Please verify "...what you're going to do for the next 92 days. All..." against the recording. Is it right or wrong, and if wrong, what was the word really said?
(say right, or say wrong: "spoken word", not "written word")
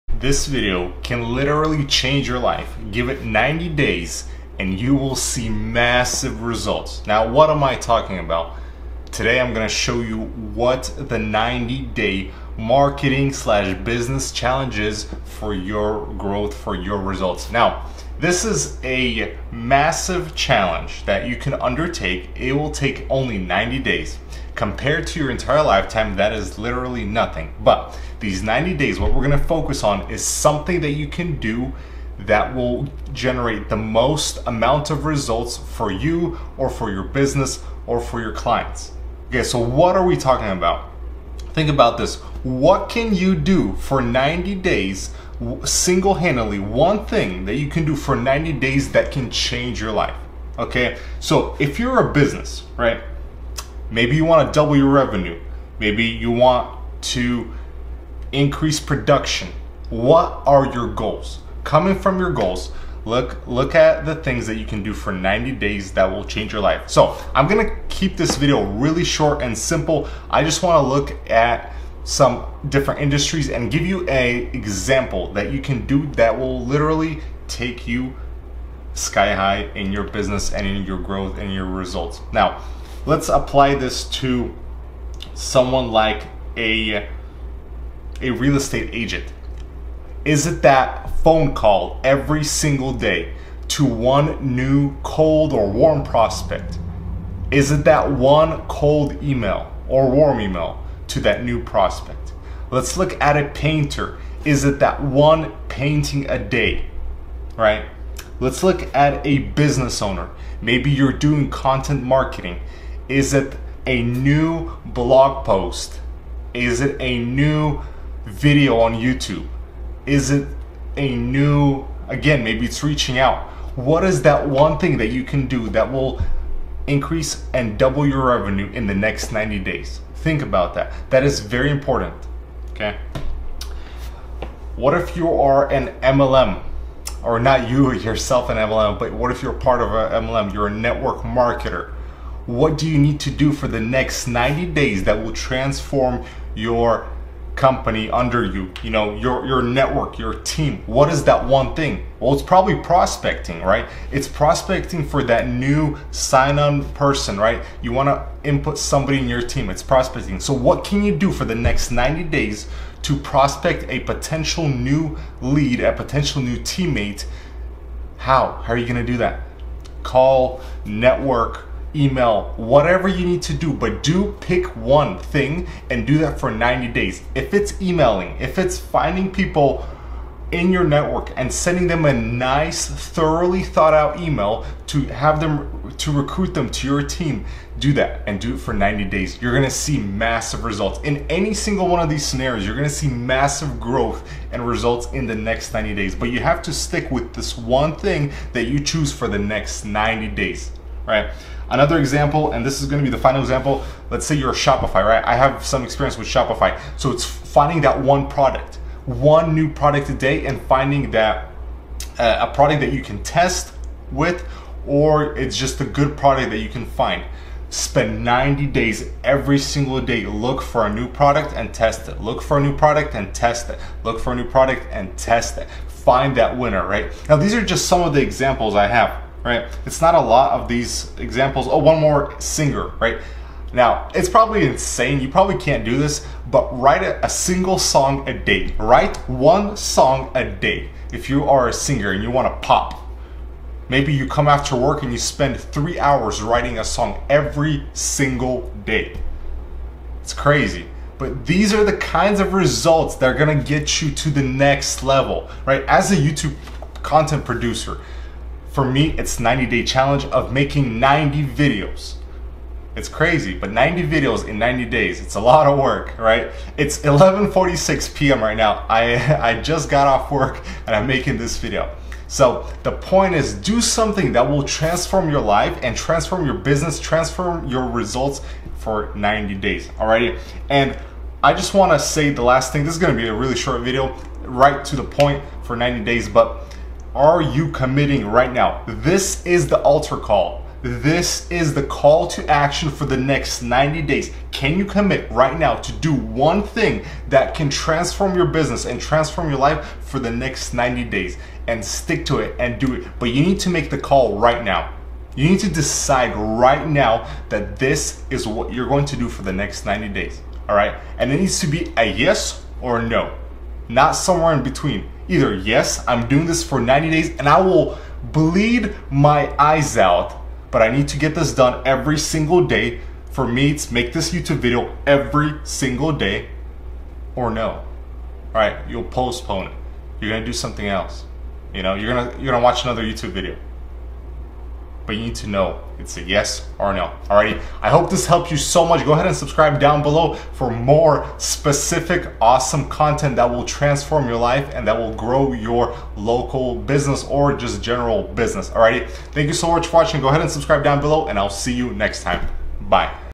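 wrong: "90", not "92".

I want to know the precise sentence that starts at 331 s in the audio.
You know, you're gonna you're gonna watch another YouTube video but you need to know.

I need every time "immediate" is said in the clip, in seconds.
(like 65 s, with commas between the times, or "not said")
not said.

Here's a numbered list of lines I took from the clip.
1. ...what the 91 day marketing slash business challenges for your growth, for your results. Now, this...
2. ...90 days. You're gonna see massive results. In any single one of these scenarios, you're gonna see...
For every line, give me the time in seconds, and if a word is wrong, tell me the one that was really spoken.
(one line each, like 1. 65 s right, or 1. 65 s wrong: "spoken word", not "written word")
1. 10 s wrong: "90", not "91"
2. 188 s right.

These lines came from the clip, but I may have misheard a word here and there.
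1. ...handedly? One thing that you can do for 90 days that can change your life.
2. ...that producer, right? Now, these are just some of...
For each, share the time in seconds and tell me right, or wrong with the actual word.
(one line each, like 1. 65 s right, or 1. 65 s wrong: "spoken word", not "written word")
1. 46 s right
2. 226 s wrong: "winner", not "producer".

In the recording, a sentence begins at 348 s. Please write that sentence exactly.
Alrighty, thank you so much for watching.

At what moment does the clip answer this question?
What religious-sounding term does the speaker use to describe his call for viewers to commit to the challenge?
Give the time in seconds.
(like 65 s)
289 s.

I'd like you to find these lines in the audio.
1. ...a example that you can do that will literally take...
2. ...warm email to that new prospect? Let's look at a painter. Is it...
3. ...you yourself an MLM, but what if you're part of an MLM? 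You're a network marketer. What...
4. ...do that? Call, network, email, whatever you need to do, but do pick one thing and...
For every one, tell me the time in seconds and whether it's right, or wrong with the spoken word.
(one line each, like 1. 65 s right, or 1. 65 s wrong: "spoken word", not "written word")
1. 74 s right
2. 100 s right
3. 137 s right
4. 169 s right.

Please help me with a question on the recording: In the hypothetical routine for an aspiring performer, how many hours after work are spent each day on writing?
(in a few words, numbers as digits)
3 hours.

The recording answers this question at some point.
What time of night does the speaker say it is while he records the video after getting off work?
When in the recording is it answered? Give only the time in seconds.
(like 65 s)
266 s.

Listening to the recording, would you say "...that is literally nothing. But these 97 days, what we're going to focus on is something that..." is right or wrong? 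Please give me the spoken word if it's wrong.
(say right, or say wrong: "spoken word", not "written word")
wrong: "90", not "97".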